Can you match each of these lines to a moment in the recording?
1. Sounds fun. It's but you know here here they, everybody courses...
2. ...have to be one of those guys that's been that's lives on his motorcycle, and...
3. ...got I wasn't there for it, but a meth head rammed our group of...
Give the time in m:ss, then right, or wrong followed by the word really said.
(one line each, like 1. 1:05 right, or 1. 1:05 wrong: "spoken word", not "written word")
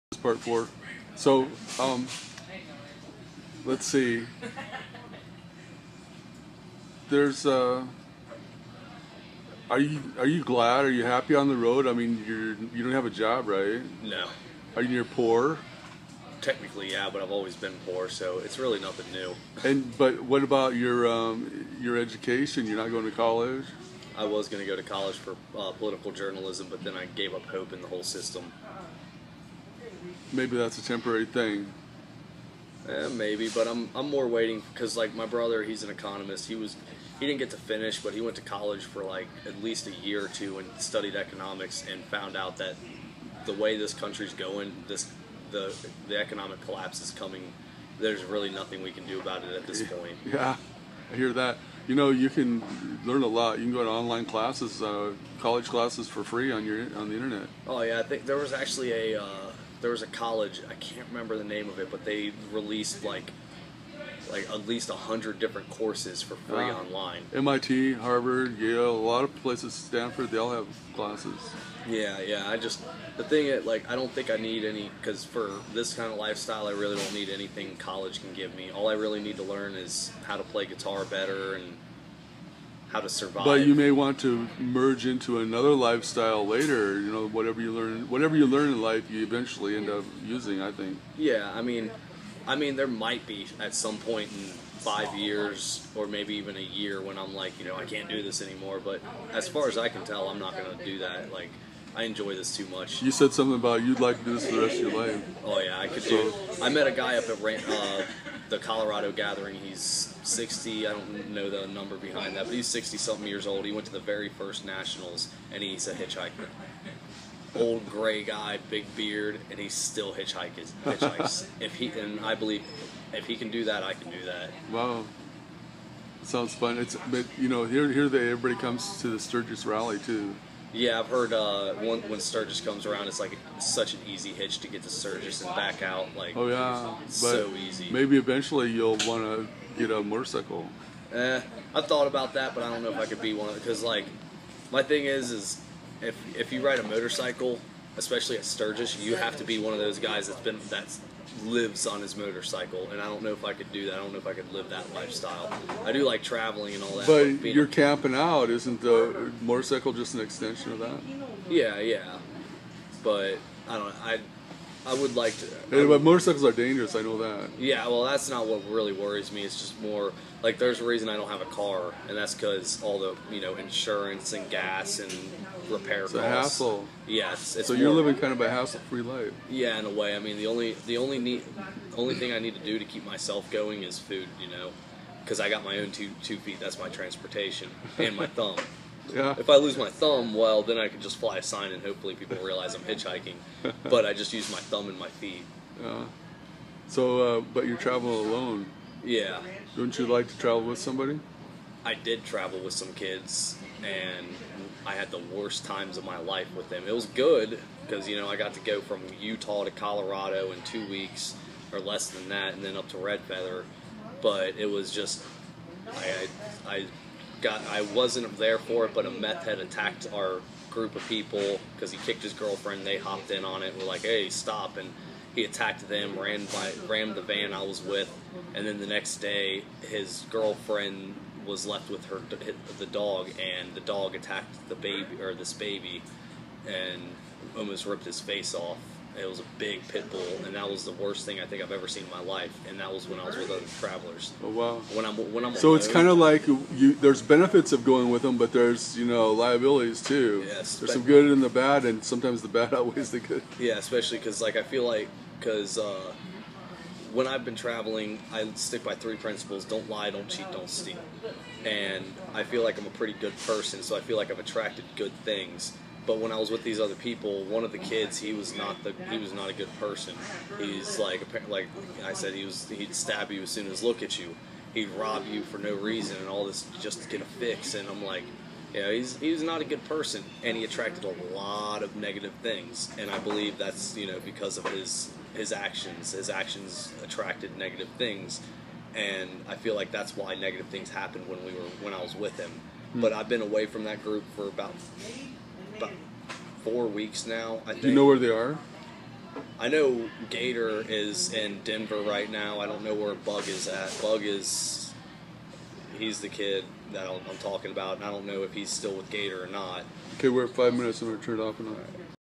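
1. 2:06 wrong: "comes", not "courses"
2. 2:29 right
3. 3:37 wrong: "attacked", not "rammed".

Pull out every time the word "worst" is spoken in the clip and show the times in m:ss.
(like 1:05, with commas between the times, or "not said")
3:25, 4:00.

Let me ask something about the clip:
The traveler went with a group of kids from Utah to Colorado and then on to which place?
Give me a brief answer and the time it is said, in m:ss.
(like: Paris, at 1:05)
Red Feather, at 3:32.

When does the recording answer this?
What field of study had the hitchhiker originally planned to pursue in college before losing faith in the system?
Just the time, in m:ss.
0:25.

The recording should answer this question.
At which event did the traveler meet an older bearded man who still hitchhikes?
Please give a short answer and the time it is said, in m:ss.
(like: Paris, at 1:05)
Colorado Gathering, at 1:48.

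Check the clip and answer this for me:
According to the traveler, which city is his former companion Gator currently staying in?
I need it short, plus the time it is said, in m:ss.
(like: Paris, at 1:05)
Denver, at 5:01.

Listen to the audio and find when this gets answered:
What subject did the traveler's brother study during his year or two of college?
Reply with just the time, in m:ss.
0:41.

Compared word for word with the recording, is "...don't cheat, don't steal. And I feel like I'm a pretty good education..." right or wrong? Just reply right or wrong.
wrong.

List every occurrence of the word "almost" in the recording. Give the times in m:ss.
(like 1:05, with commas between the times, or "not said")
3:57.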